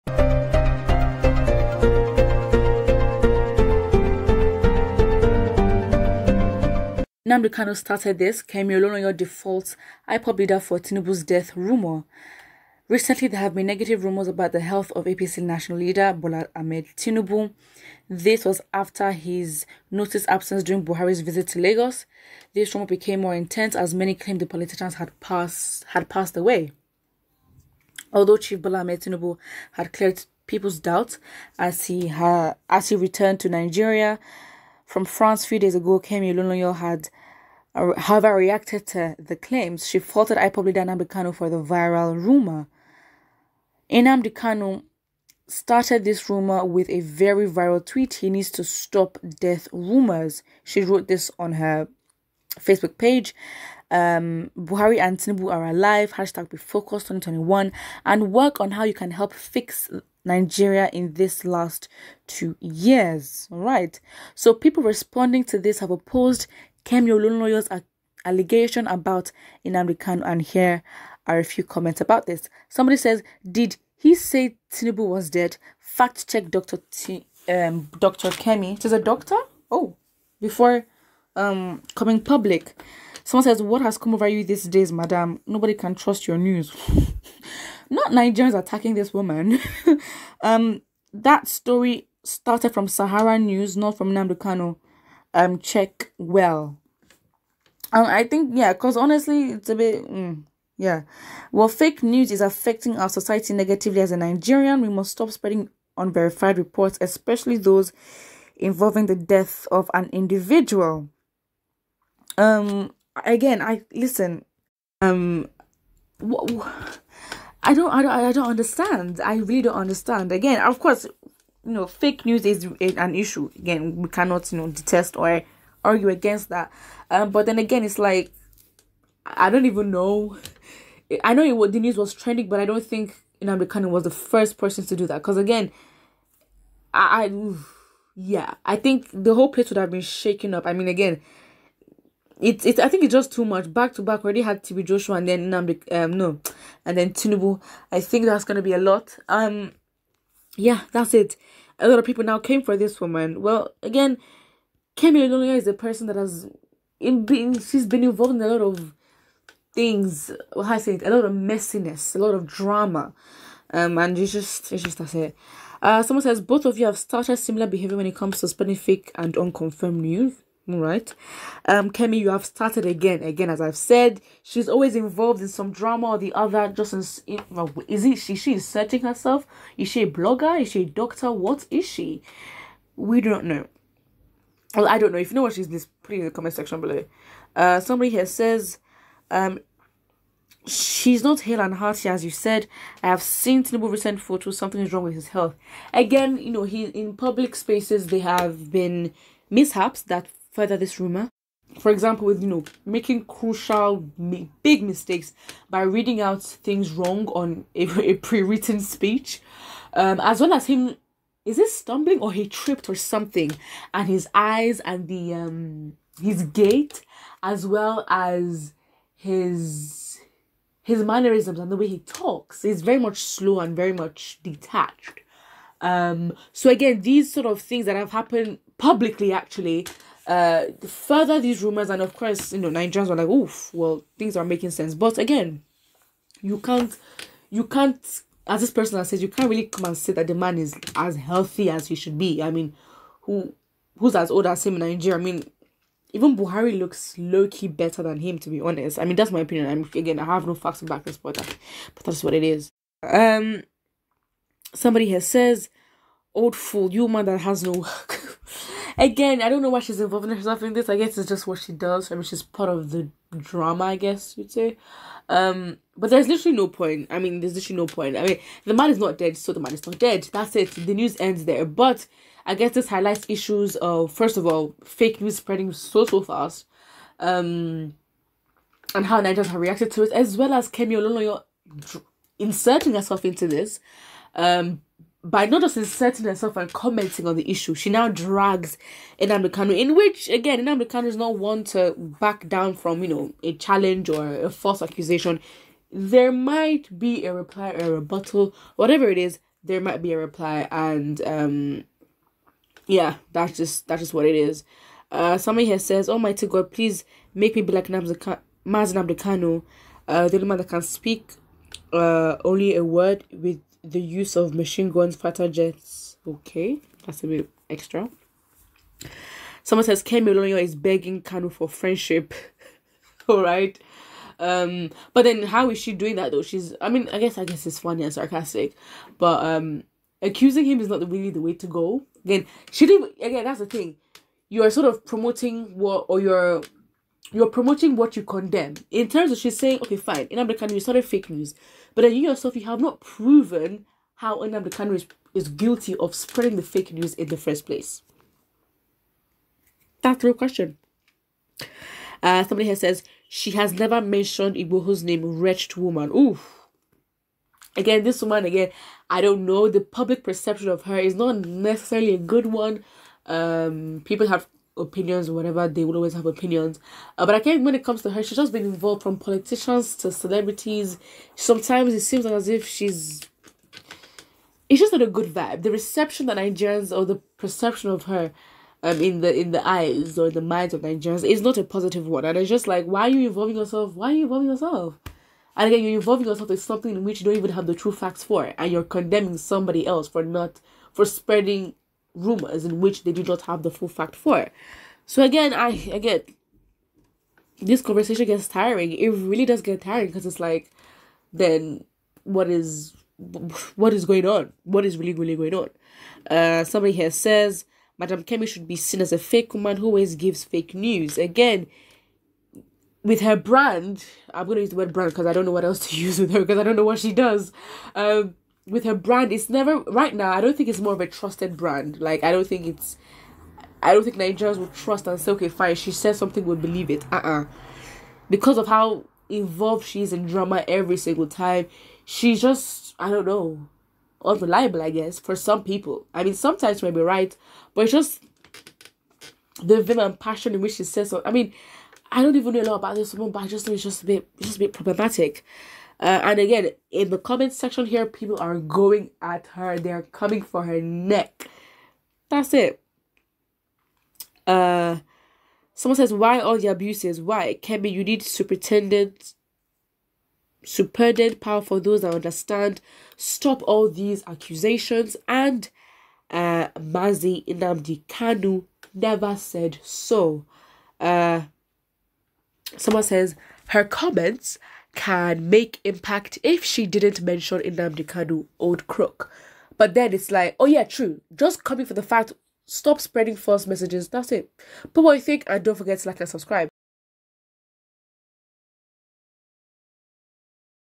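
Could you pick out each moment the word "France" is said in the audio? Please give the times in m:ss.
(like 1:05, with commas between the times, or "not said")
0:35.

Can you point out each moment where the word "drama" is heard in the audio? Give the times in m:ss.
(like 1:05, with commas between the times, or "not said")
2:42, 2:55, 4:23, 7:10.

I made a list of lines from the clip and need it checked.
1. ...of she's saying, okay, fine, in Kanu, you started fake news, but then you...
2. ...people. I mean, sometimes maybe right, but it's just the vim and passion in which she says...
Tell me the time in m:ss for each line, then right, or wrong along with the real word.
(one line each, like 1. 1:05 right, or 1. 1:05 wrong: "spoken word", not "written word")
1. 5:39 right
2. 7:15 right.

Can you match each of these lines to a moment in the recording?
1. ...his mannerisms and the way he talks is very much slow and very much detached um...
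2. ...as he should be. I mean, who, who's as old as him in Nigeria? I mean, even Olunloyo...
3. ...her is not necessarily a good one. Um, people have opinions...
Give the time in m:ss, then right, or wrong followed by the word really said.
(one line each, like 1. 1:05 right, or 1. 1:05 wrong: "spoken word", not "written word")
1. 3:40 right
2. 4:01 wrong: "Buhari", not "Olunloyo"
3. 6:00 right.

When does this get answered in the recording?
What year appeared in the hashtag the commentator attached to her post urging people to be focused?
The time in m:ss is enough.
0:57.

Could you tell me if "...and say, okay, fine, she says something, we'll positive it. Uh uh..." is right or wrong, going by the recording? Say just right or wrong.
wrong.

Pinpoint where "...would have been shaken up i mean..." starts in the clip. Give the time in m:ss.
2:19.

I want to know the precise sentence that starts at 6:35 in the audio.
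So again, I again this conversation gets tiring.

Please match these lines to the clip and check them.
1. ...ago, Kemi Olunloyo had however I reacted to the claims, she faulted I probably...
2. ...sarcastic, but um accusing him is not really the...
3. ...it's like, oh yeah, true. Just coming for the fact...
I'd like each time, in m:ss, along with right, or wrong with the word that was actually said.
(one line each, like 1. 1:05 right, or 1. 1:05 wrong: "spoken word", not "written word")
1. 0:35 right
2. 5:28 right
3. 8:00 right.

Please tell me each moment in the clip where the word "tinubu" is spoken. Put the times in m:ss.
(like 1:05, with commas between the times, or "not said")
0:10, 0:16, 0:29, 0:55, 1:14, 2:27, 3:13.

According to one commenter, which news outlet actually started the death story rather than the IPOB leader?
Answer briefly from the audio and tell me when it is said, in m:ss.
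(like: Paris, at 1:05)
Sahara News, at 1:32.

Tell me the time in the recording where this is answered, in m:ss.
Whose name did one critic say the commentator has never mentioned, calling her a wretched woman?
5:54.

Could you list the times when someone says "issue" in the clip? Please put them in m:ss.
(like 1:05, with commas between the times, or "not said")
2:03, 4:33, 4:47.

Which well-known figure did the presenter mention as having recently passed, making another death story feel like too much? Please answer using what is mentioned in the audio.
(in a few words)
TB Joshua.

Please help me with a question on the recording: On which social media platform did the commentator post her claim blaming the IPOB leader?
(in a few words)
Facebook.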